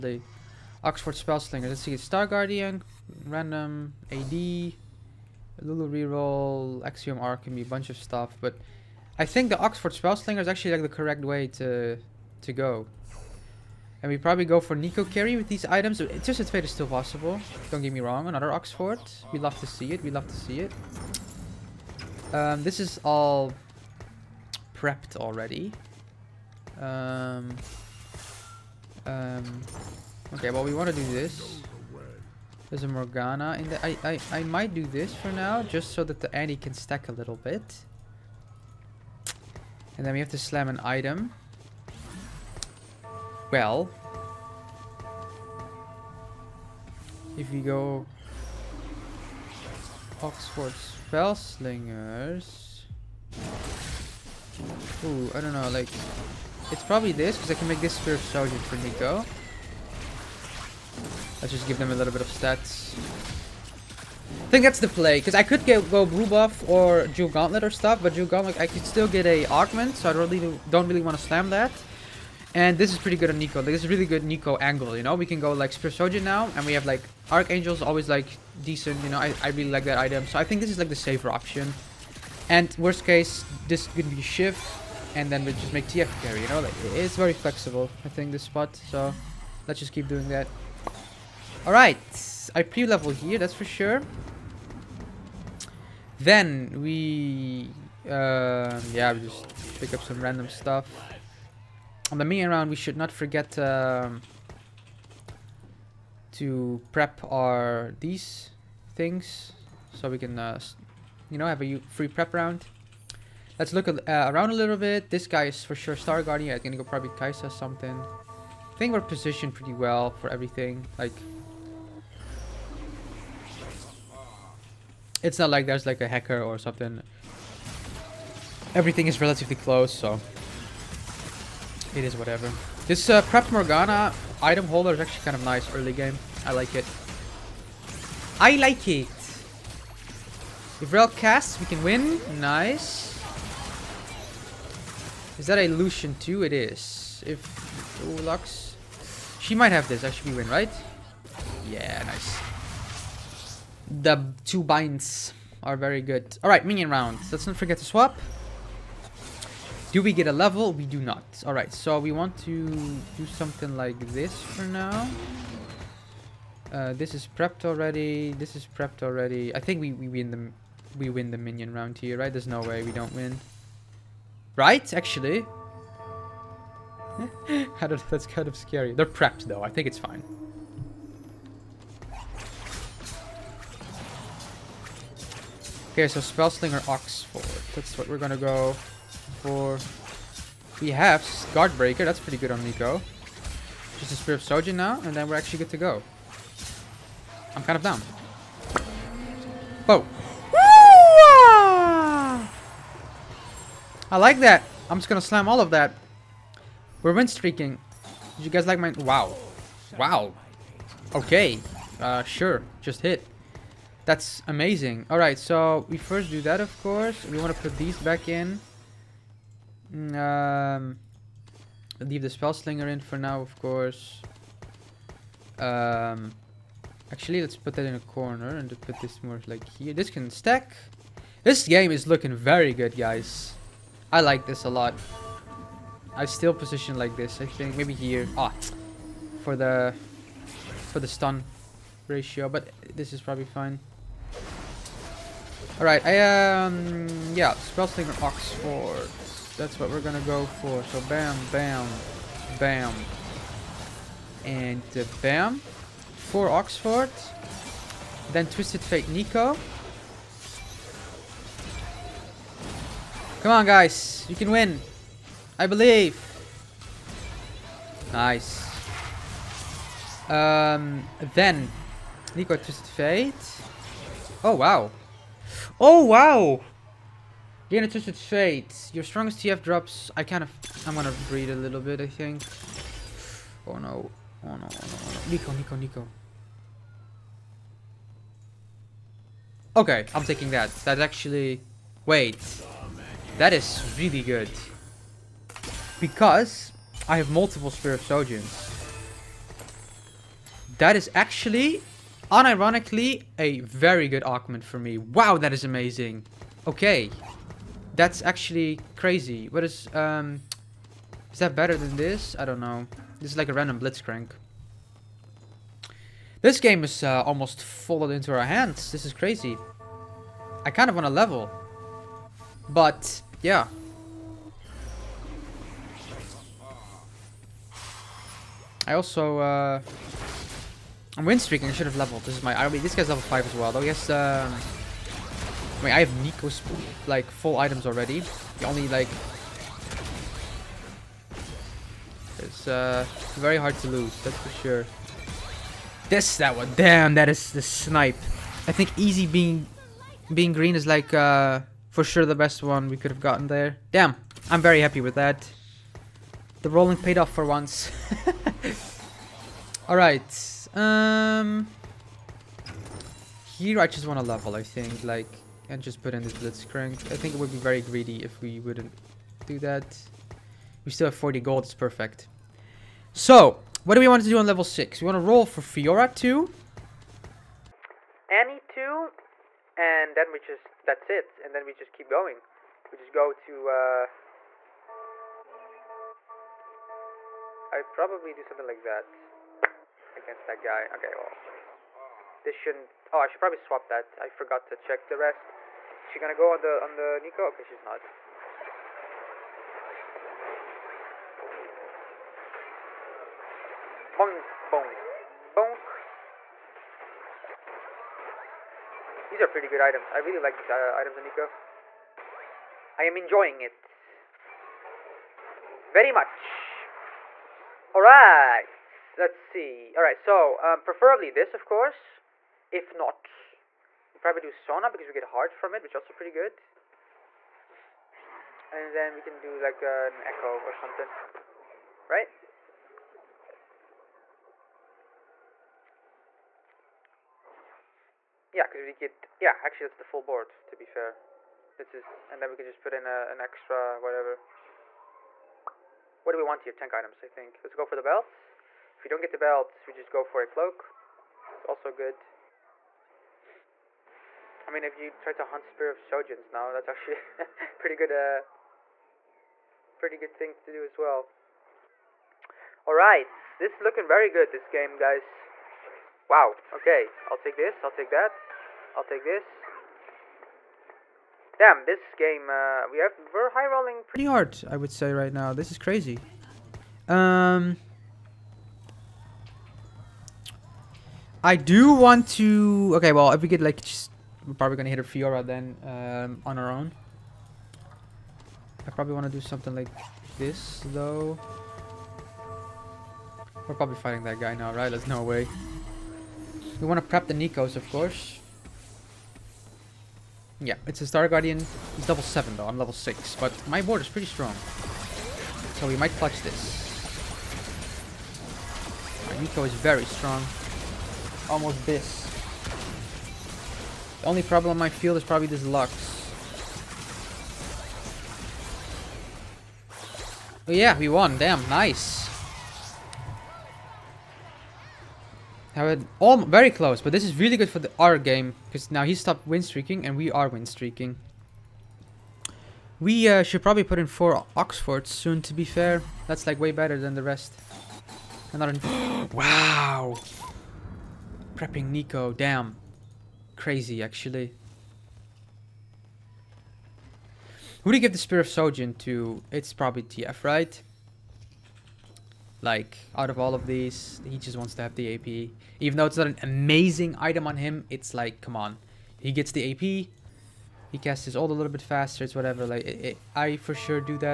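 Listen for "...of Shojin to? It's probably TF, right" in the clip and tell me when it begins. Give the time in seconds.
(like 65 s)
548 s.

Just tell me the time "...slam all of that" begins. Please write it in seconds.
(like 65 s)
205 s.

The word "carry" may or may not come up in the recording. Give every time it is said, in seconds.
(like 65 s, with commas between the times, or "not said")
15 s, 86 s.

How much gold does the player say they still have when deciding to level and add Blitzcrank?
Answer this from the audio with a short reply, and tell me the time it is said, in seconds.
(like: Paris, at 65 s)
40, at 371 s.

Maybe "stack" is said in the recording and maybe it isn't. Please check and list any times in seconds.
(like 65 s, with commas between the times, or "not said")
36 s, 230 s.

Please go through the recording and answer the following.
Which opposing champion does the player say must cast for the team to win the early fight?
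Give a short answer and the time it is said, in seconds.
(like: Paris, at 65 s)
Rell, at 140 s.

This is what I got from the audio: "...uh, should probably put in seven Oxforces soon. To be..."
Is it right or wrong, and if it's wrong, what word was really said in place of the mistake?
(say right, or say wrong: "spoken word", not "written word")
wrong: "four", not "seven".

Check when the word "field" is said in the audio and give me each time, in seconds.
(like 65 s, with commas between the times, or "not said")
514 s.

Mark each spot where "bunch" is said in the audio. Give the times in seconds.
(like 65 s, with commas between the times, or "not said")
7 s.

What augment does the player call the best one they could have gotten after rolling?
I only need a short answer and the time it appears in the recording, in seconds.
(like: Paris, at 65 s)
Being Green, at 348 s.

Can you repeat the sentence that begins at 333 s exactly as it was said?
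He has um I mean I have Neeko's like full items already.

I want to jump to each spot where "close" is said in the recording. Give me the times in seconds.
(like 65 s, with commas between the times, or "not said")
129 s, 526 s.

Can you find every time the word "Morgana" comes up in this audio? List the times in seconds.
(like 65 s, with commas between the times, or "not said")
32 s, 133 s.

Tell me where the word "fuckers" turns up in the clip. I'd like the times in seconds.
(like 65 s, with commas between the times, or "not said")
not said.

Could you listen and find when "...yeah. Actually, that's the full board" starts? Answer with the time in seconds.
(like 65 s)
439 s.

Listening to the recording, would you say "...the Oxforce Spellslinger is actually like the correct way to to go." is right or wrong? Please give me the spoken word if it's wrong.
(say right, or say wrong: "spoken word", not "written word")
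right.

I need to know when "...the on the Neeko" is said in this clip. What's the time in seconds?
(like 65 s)
396 s.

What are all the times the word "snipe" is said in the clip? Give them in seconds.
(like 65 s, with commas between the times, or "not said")
347 s.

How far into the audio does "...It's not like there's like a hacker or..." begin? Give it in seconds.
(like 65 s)
125 s.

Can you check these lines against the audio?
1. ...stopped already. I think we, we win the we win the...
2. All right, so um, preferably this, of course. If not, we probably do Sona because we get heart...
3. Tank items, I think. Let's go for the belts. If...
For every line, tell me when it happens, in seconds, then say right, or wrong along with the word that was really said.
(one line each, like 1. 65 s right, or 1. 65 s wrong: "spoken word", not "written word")
1. 168 s wrong: "prepped", not "stopped"
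2. 419 s right
3. 446 s right.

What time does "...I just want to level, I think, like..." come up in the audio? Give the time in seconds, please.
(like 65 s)
363 s.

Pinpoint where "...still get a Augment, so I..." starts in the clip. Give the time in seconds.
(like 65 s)
68 s.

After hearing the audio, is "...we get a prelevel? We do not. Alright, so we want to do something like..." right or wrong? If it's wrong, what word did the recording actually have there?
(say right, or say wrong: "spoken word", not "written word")
wrong: "level", not "prelevel".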